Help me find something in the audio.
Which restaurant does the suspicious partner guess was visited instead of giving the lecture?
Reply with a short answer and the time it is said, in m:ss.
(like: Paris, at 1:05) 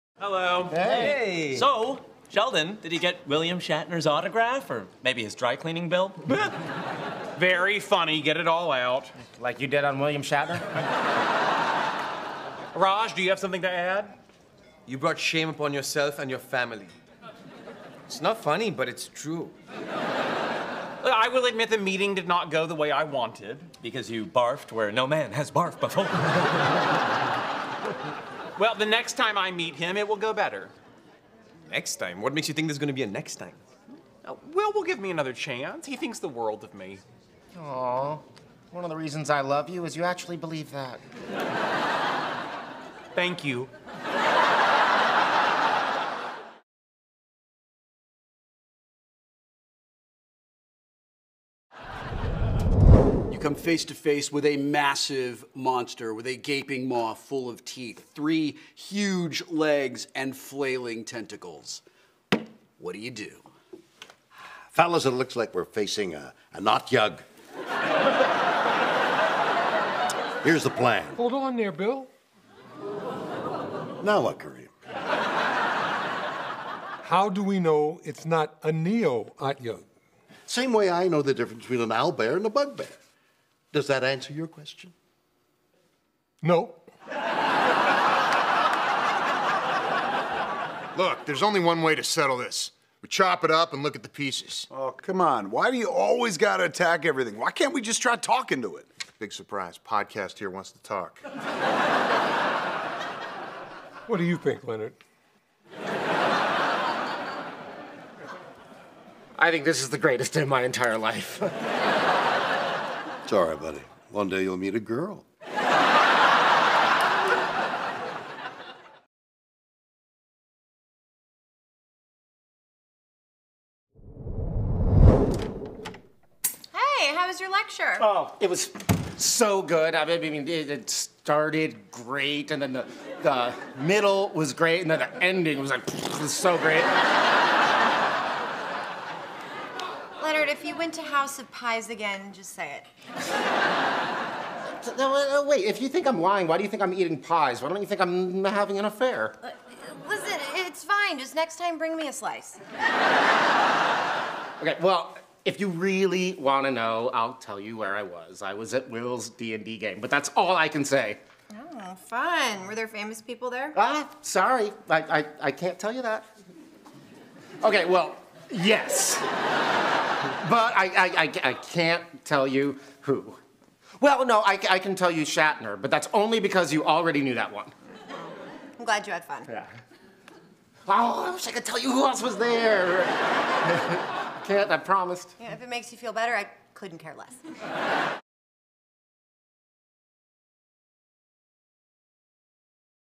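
House of Pies, at 2:21.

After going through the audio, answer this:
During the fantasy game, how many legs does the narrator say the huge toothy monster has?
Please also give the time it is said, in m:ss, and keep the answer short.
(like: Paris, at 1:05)
3, at 0:58.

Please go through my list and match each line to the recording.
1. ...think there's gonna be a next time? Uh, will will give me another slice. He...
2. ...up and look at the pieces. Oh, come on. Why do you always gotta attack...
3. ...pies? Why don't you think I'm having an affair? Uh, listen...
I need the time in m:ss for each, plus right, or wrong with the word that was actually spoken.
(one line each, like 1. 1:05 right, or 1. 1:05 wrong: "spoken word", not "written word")
1. 0:32 wrong: "chance", not "slice"
2. 1:33 right
3. 2:27 right.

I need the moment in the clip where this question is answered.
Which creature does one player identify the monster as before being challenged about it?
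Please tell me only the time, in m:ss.
1:06.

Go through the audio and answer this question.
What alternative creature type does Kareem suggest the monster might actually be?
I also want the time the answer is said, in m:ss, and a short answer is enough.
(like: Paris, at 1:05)
neo-otyugh, at 1:18.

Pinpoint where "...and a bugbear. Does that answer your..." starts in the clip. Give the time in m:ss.
1:22.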